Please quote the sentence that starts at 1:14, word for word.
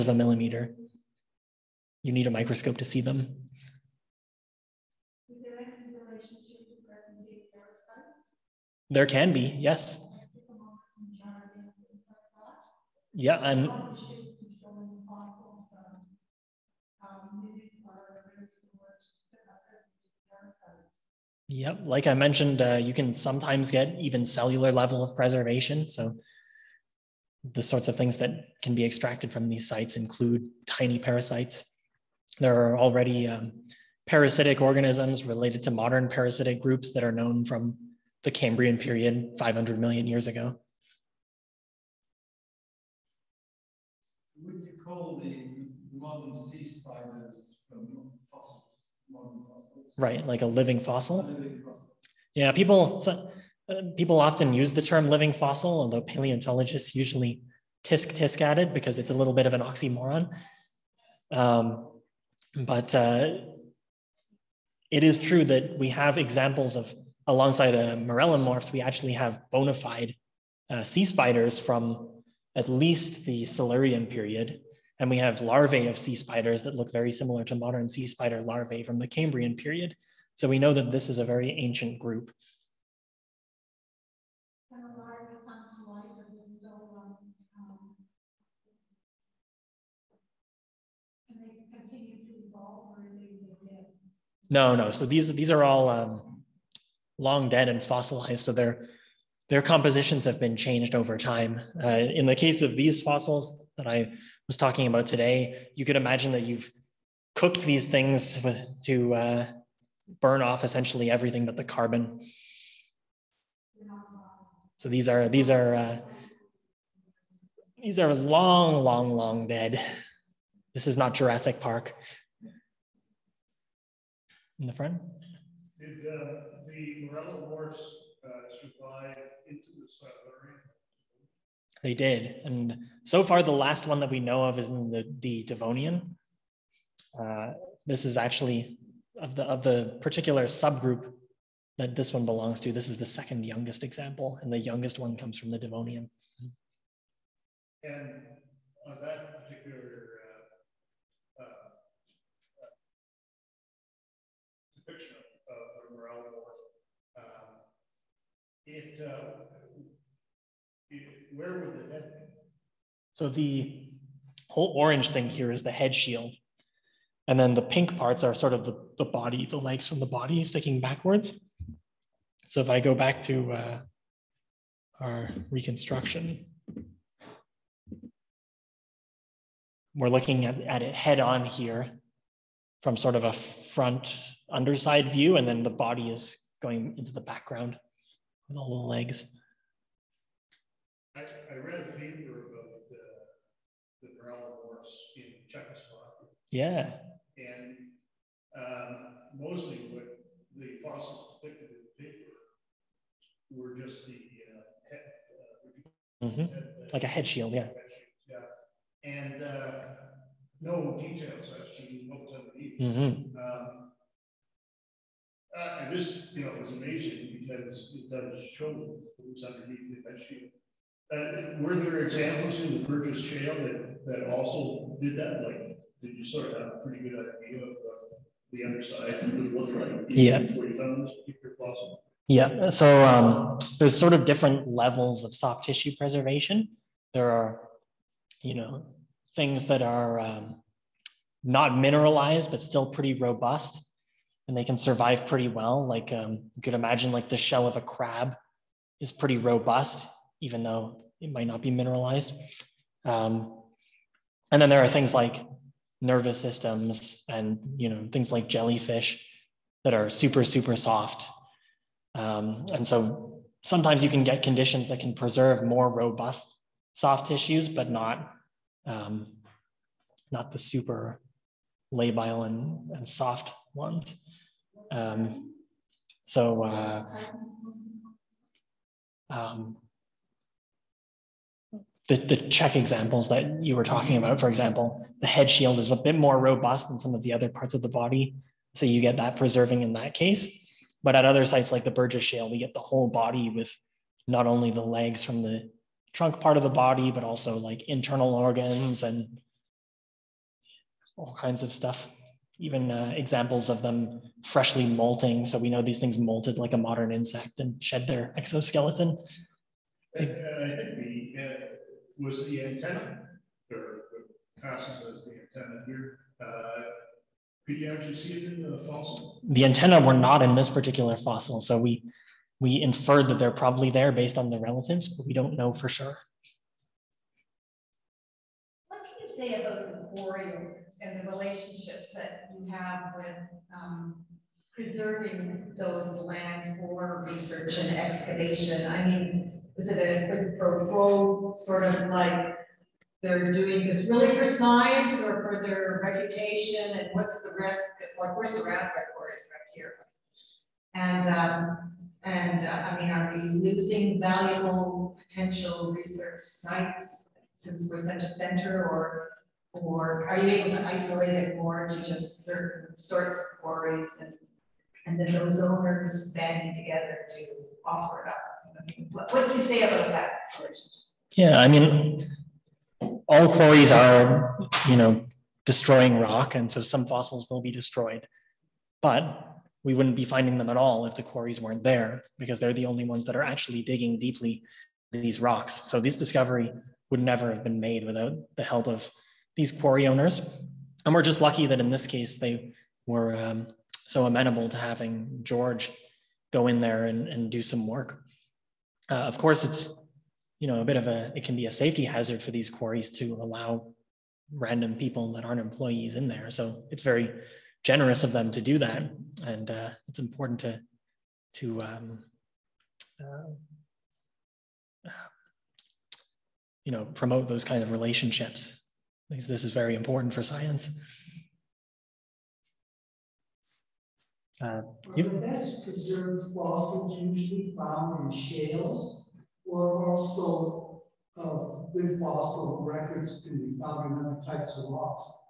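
And we have larvae of sea spiders that look very similar to modern sea spider larvae from the Cambrian period.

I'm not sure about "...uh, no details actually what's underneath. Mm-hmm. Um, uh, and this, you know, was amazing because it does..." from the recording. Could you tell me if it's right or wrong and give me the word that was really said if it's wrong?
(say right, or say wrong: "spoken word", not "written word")
right.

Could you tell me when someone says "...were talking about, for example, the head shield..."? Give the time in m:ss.
4:43.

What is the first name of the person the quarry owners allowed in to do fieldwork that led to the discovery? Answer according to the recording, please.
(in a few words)
George.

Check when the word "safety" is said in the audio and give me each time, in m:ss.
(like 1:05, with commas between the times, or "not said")
6:41.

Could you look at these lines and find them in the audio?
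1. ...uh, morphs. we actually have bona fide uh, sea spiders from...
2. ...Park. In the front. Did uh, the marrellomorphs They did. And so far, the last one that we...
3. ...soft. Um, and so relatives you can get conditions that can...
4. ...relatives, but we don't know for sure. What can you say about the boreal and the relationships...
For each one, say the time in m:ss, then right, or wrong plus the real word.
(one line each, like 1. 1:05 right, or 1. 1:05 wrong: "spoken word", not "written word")
1. 1:07 right
2. 2:01 right
3. 4:20 wrong: "sometimes", not "relatives"
4. 5:24 right.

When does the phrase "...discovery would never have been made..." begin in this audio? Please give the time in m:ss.
6:26.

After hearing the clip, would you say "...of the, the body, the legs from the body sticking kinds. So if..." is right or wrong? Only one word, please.
wrong.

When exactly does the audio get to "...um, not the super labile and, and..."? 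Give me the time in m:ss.
4:28.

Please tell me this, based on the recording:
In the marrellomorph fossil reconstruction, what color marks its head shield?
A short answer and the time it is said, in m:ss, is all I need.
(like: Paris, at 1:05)
Orange, at 2:44.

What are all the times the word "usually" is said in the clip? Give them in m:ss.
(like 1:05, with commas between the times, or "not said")
0:56, 7:07.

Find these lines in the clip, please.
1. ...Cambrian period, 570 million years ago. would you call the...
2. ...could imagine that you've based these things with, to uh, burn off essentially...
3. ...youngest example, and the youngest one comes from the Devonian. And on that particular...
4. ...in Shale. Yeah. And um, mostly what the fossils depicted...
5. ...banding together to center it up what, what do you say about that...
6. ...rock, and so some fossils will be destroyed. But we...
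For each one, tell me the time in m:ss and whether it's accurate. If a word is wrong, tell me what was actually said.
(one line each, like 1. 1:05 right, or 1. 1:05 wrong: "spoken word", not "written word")
1. 0:38 wrong: "500", not "570"
2. 1:45 wrong: "cooked", not "based"
3. 2:23 right
4. 3:15 wrong: "Czechoslovakia", not "Shale"
5. 6:06 wrong: "offer", not "center"
6. 6:16 right.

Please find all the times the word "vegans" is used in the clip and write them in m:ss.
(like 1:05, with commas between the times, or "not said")
not said.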